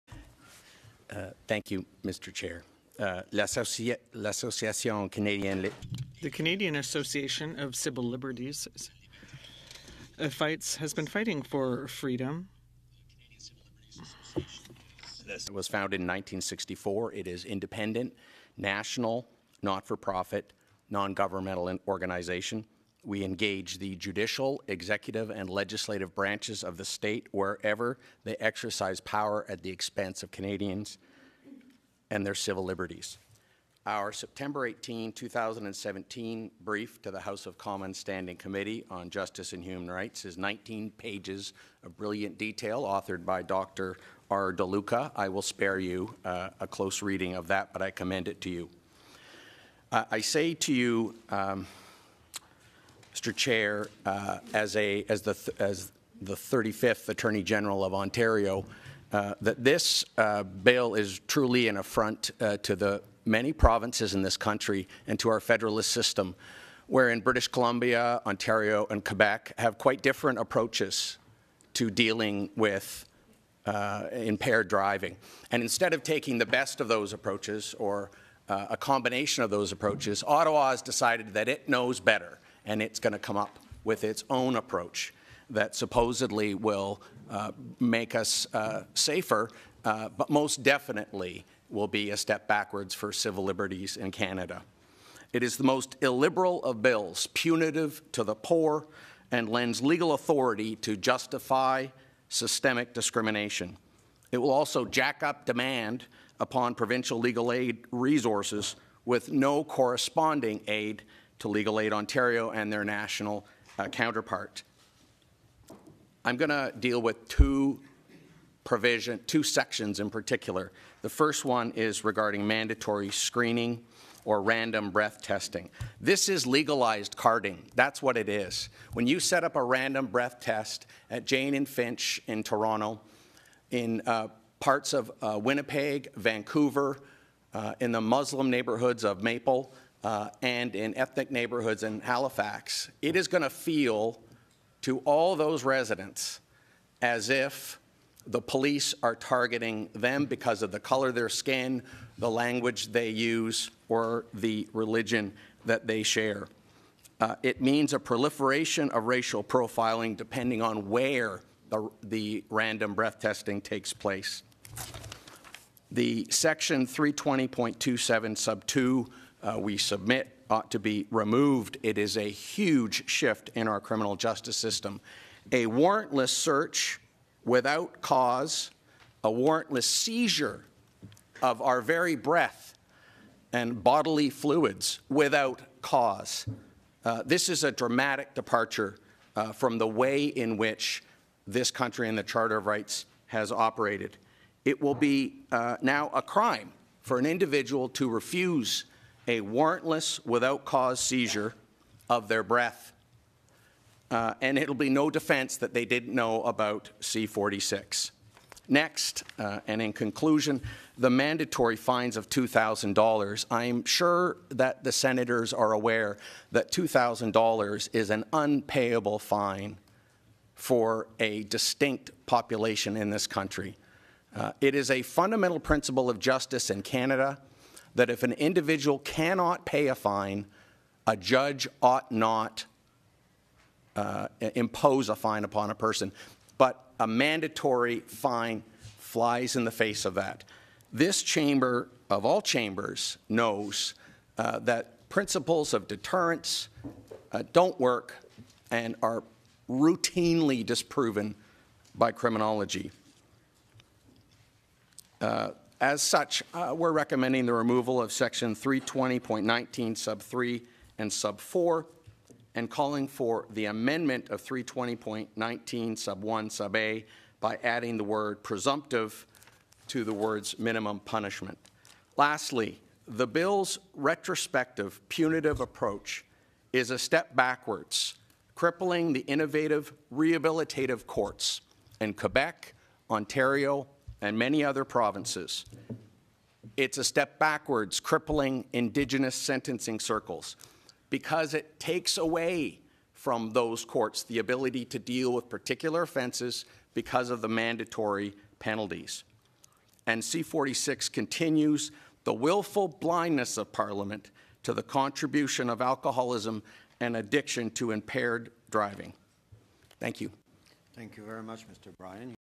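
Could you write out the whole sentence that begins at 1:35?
It is the most illiberal of bills, punitive to the poor, and lends legal authority to justify systemic discrimination.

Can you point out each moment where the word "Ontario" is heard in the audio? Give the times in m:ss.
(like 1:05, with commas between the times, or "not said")
0:57, 1:08, 1:51, 4:43.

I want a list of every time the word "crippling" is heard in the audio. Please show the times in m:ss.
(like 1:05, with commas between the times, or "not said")
4:38, 4:47.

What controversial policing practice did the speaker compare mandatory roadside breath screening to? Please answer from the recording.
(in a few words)
Legalized carding.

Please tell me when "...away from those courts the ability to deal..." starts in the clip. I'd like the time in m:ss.
4:52.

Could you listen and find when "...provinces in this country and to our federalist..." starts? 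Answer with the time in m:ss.
1:03.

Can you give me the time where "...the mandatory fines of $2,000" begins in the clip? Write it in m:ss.
3:30.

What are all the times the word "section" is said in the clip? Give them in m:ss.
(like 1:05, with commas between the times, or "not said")
1:59, 2:46, 4:18.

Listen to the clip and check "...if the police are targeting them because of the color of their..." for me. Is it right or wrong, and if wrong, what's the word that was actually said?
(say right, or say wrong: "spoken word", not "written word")
right.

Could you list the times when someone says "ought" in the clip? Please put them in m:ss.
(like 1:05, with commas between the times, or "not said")
2:50, 3:51.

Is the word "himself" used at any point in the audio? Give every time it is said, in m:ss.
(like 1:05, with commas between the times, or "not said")
not said.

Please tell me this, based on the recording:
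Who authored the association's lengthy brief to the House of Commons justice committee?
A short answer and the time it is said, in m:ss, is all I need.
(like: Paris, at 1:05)
Dr. R. DeLuca, at 0:43.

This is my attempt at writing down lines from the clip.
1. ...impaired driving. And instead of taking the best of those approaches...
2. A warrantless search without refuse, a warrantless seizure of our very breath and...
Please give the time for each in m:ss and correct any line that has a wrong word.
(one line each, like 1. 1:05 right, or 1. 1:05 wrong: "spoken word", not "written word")
1. 1:14 right
2. 2:55 wrong: "cause", not "refuse".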